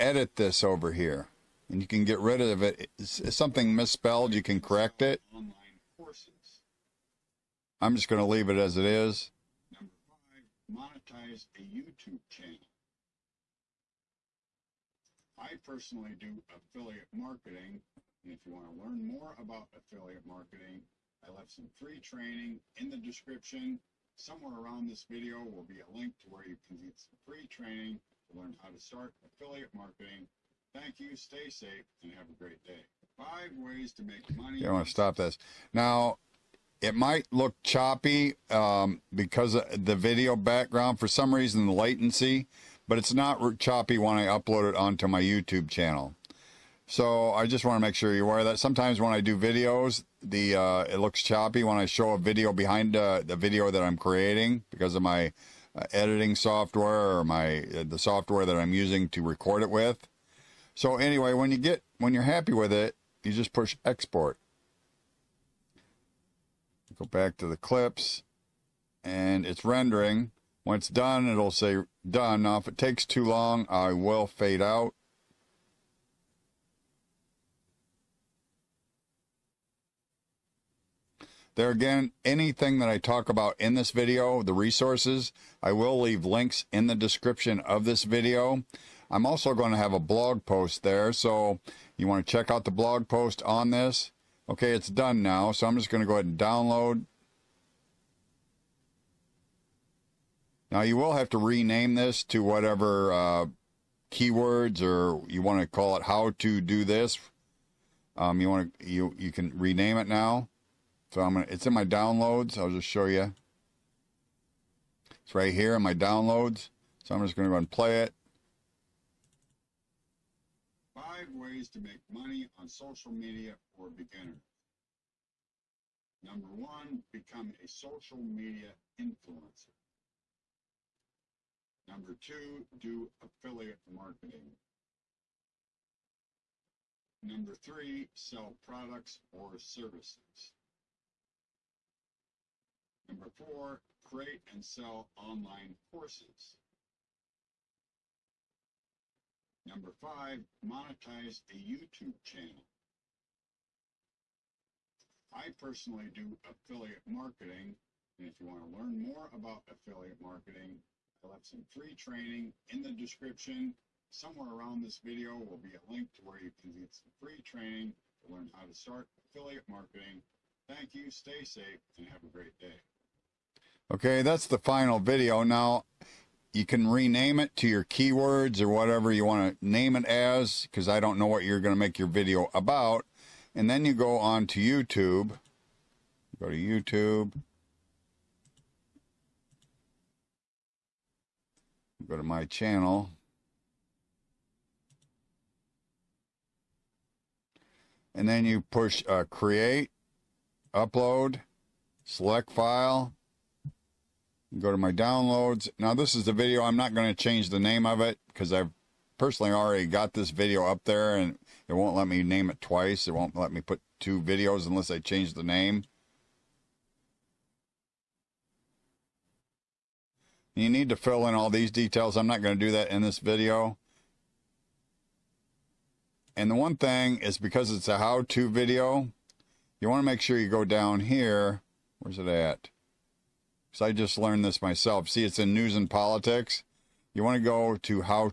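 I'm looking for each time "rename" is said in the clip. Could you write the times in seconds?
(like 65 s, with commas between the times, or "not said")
101 s, 109 s, 176 s.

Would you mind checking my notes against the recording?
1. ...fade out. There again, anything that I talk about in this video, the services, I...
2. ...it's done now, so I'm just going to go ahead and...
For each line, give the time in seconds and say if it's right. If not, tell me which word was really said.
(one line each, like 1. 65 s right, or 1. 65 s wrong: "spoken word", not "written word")
1. 74 s wrong: "resources", not "services"
2. 94 s right.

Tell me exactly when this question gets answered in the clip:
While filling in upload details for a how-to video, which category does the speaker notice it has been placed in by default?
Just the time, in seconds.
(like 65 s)
235 s.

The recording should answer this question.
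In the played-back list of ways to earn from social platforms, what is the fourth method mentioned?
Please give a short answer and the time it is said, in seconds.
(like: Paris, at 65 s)
Create and sell online courses, at 144 s.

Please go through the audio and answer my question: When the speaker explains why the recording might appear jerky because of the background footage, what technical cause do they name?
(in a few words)
latency.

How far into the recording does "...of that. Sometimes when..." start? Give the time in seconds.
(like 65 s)
48 s.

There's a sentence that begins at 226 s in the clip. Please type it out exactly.
And the one thing is because it's a how-to video, you want to make sure you go down here.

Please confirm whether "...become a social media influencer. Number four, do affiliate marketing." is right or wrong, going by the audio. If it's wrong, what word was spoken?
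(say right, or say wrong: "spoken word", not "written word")
wrong: "two", not "four".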